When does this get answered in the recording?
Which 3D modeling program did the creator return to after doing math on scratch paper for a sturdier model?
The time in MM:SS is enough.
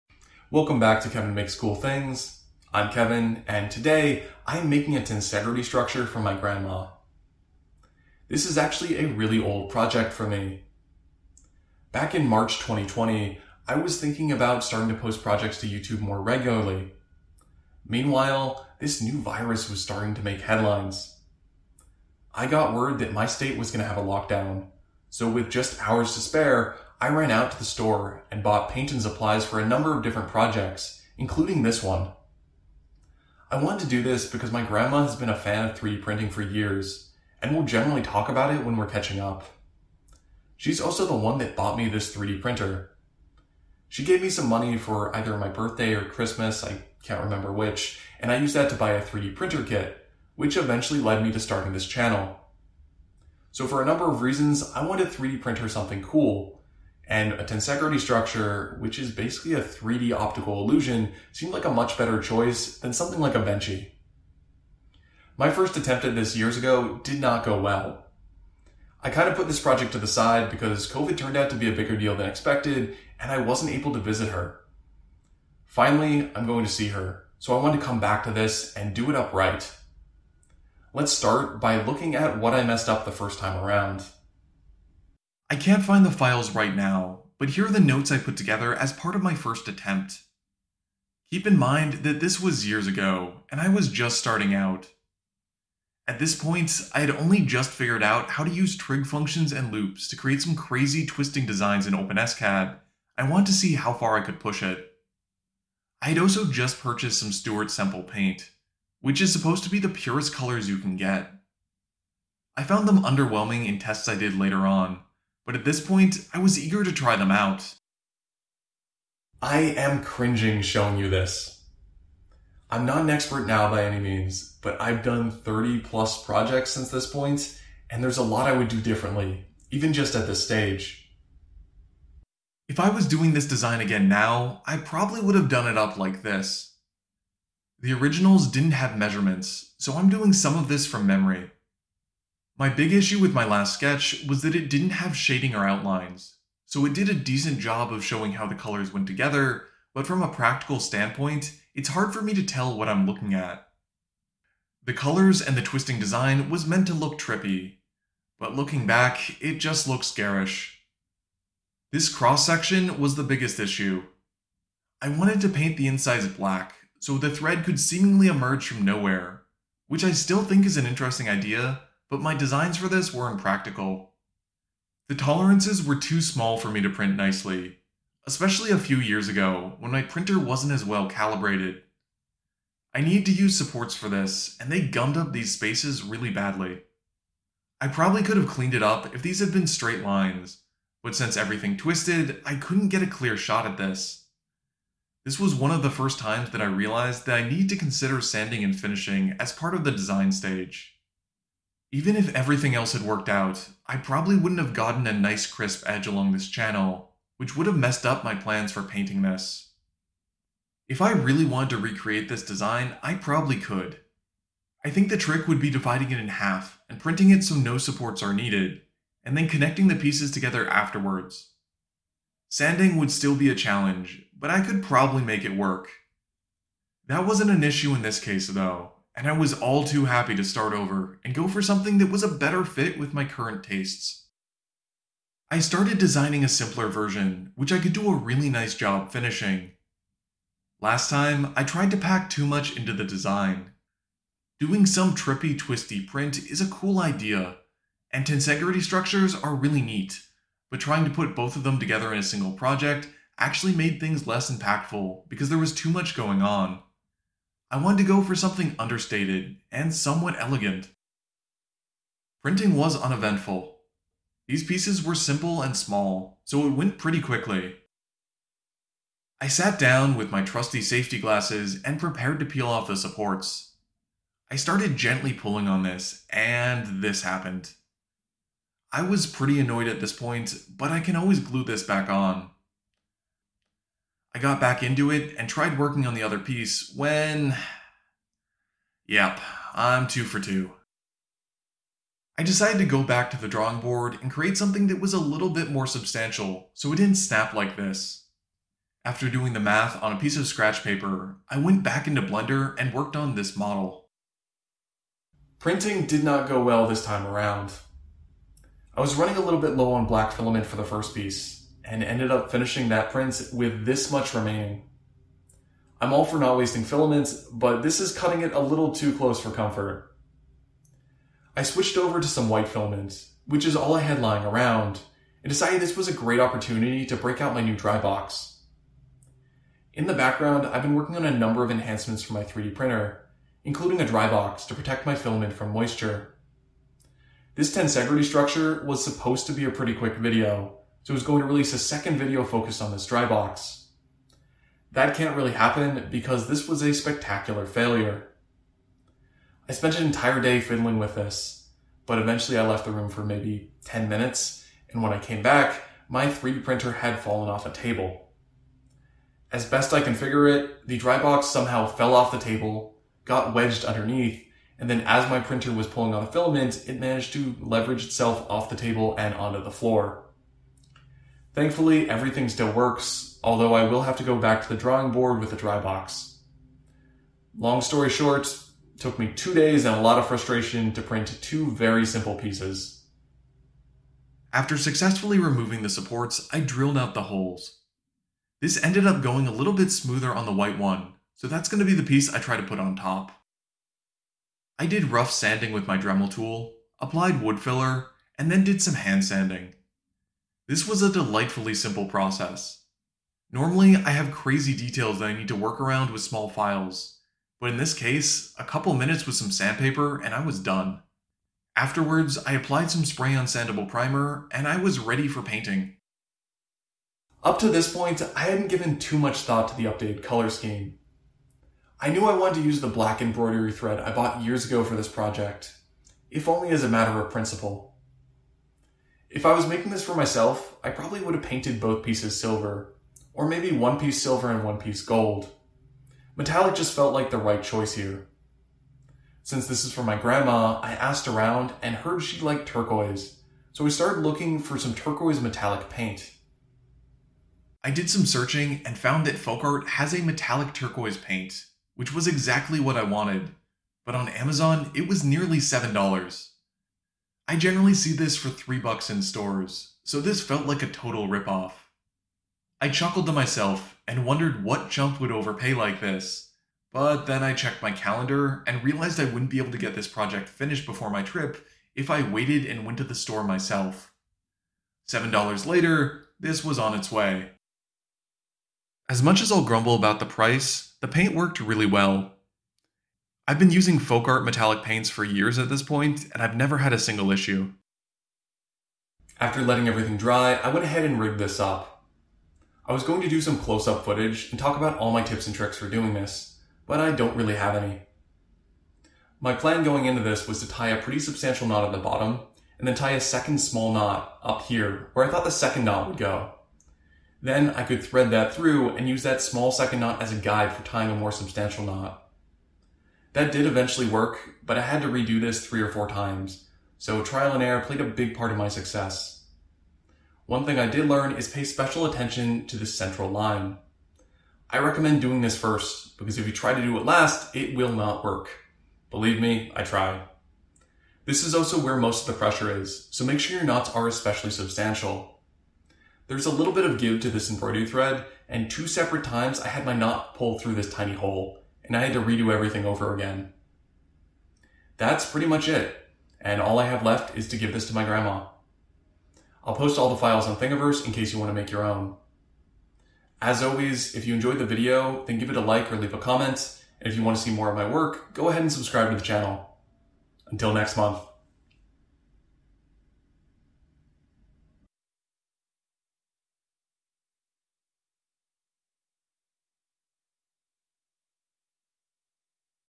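05:02.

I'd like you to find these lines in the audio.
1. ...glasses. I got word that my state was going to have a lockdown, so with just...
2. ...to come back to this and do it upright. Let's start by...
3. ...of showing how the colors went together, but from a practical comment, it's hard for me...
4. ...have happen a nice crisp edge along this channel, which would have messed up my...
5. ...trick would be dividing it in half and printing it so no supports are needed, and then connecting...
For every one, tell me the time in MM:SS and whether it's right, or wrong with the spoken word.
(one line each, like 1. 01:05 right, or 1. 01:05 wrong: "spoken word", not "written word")
1. 00:20 wrong: "headlines", not "glasses"
2. 01:17 right
3. 02:27 wrong: "standpoint", not "comment"
4. 03:24 wrong: "gotten", not "happen"
5. 03:35 right.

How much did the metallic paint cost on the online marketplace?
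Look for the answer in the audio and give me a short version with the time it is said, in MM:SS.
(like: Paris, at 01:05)
$7, at 07:35.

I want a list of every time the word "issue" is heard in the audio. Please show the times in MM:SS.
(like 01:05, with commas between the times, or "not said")
02:22, 02:43, 03:47, 08:07.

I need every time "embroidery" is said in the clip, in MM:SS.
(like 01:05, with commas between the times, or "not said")
07:03, 08:57.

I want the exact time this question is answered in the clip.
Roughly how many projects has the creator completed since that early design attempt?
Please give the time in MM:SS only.
02:05.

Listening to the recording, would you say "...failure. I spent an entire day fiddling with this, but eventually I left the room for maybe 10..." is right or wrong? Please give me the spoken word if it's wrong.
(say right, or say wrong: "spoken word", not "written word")
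right.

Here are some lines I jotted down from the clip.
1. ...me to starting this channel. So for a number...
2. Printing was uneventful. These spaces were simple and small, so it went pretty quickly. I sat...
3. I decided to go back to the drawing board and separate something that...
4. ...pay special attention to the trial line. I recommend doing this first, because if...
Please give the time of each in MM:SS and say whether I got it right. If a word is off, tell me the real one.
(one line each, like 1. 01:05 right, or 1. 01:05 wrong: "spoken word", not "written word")
1. 00:51 right
2. 04:22 wrong: "pieces", not "spaces"
3. 04:52 wrong: "create", not "separate"
4. 08:41 wrong: "central", not "trial".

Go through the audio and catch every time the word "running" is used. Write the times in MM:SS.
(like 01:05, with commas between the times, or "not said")
05:09.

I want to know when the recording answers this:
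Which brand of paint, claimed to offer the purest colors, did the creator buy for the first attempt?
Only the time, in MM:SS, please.
01:47.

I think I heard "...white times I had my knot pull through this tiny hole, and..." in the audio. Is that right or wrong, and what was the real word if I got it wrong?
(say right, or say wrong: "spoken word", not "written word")
wrong: "separate", not "white".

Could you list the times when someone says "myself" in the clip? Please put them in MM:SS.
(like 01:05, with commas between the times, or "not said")
07:10, 07:43, 07:53.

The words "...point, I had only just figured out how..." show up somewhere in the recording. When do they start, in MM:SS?
01:36.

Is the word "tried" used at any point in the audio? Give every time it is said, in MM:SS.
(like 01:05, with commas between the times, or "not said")
04:01, 04:45, 08:49.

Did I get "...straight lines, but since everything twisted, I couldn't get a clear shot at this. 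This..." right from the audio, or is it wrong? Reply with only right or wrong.
right.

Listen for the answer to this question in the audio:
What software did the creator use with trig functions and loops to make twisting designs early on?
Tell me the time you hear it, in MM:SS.
01:41.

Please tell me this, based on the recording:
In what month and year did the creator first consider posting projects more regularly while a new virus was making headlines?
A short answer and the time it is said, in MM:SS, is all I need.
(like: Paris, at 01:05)
March 2020, at 00:12.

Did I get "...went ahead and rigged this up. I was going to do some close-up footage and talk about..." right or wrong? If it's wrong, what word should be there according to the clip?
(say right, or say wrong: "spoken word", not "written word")
right.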